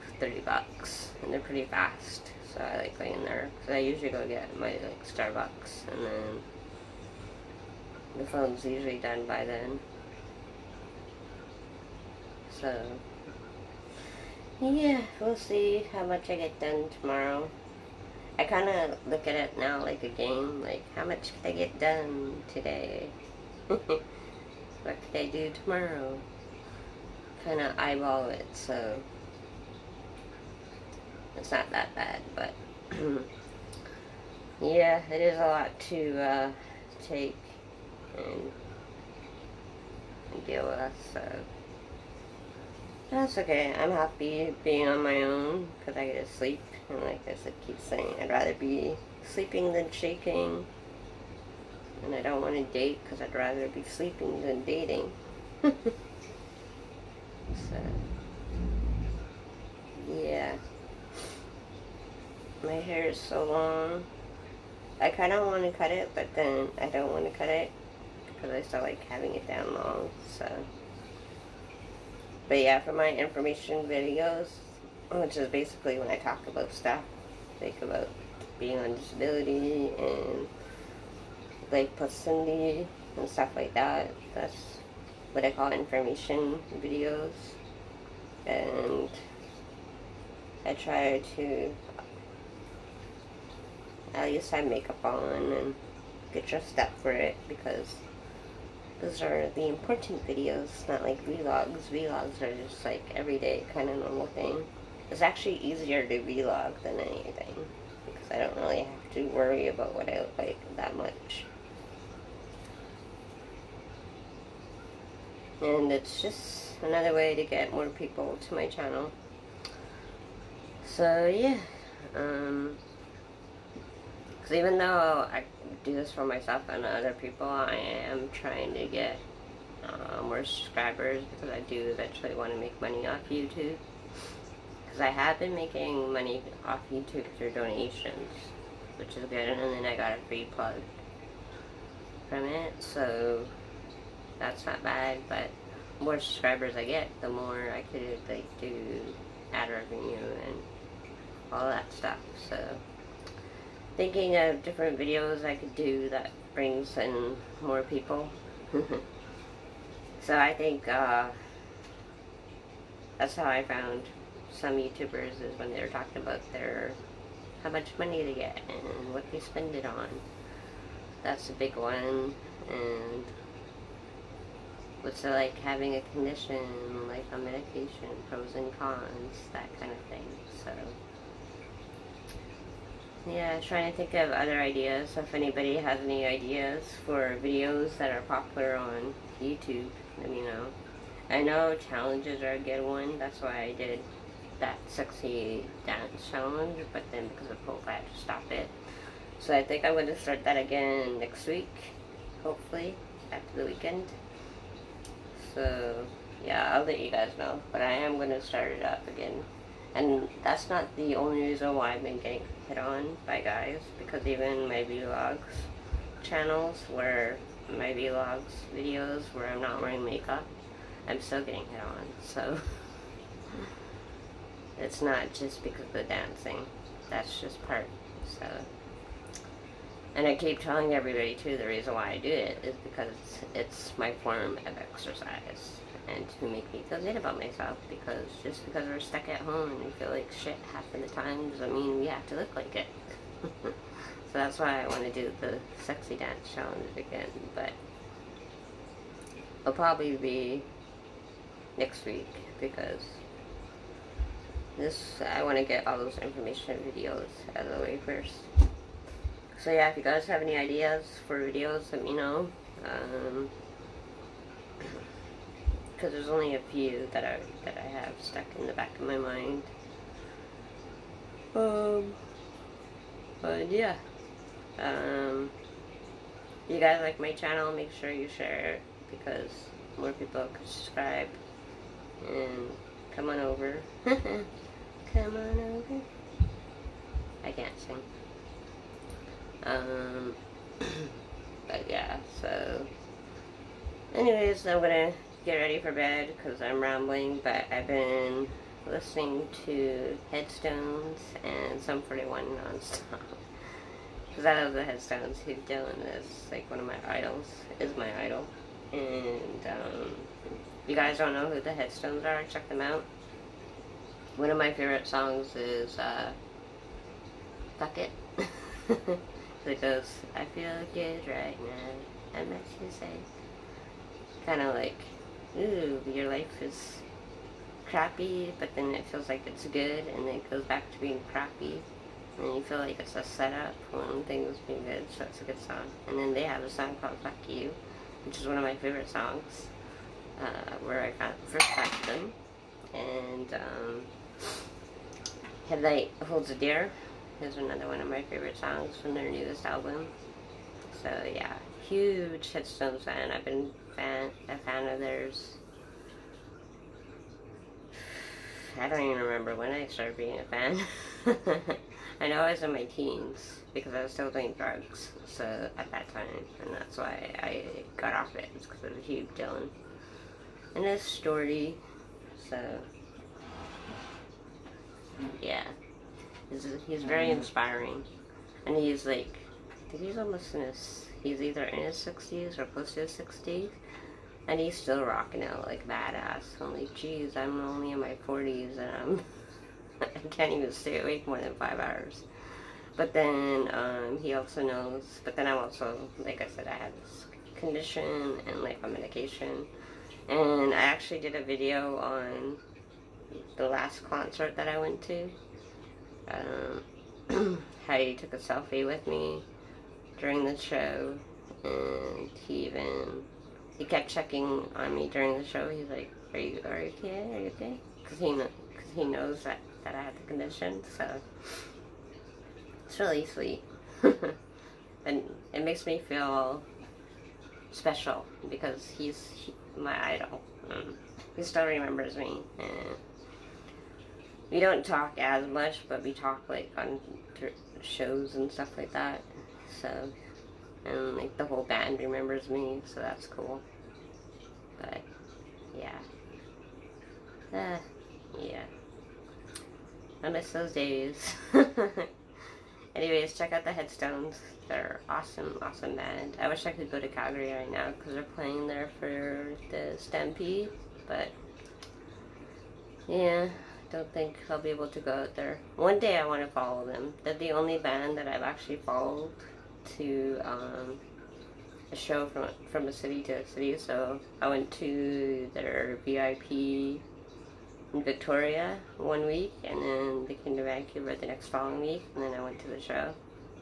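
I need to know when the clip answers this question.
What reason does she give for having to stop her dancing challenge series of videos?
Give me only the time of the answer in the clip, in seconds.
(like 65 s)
197 s.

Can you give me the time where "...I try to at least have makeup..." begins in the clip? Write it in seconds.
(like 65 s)
90 s.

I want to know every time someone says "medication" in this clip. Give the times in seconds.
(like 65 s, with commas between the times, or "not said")
177 s, 398 s.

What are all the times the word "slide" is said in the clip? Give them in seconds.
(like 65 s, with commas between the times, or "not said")
not said.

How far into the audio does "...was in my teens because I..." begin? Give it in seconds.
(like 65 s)
362 s.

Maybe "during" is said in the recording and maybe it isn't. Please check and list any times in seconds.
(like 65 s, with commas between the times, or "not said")
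410 s, 415 s.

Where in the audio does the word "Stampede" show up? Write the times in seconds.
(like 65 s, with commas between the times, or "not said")
459 s.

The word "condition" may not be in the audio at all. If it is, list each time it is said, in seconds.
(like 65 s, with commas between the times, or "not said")
176 s, 397 s, 420 s.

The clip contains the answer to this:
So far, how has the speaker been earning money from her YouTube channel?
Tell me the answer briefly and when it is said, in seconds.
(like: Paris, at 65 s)
Donations, at 137 s.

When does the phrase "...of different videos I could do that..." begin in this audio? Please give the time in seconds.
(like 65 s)
154 s.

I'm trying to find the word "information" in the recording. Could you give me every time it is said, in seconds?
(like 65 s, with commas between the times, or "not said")
73 s, 85 s, 256 s.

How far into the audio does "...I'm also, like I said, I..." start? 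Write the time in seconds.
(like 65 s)
395 s.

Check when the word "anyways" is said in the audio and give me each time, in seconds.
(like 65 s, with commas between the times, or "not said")
294 s, 452 s.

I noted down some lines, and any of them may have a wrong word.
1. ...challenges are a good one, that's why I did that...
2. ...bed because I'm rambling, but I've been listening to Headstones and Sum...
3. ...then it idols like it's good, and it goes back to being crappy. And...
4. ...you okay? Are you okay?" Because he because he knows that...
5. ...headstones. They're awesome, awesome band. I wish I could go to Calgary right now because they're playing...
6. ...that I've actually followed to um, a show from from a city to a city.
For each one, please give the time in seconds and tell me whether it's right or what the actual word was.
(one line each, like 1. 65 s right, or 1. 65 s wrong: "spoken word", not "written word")
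1. 191 s right
2. 295 s right
3. 328 s wrong: "feels", not "idols"
4. 416 s right
5. 453 s right
6. 468 s right.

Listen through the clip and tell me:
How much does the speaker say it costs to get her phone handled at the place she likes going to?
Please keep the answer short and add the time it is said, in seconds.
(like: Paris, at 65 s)
$30, at 0 s.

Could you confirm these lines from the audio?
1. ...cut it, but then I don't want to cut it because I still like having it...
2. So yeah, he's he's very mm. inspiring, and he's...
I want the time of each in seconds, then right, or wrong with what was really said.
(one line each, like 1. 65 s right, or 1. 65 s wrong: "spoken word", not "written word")
1. 65 s right
2. 372 s right.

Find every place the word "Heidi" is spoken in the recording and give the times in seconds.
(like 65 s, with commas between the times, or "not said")
407 s.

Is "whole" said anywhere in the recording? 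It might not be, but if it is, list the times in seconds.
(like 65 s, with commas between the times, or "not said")
441 s.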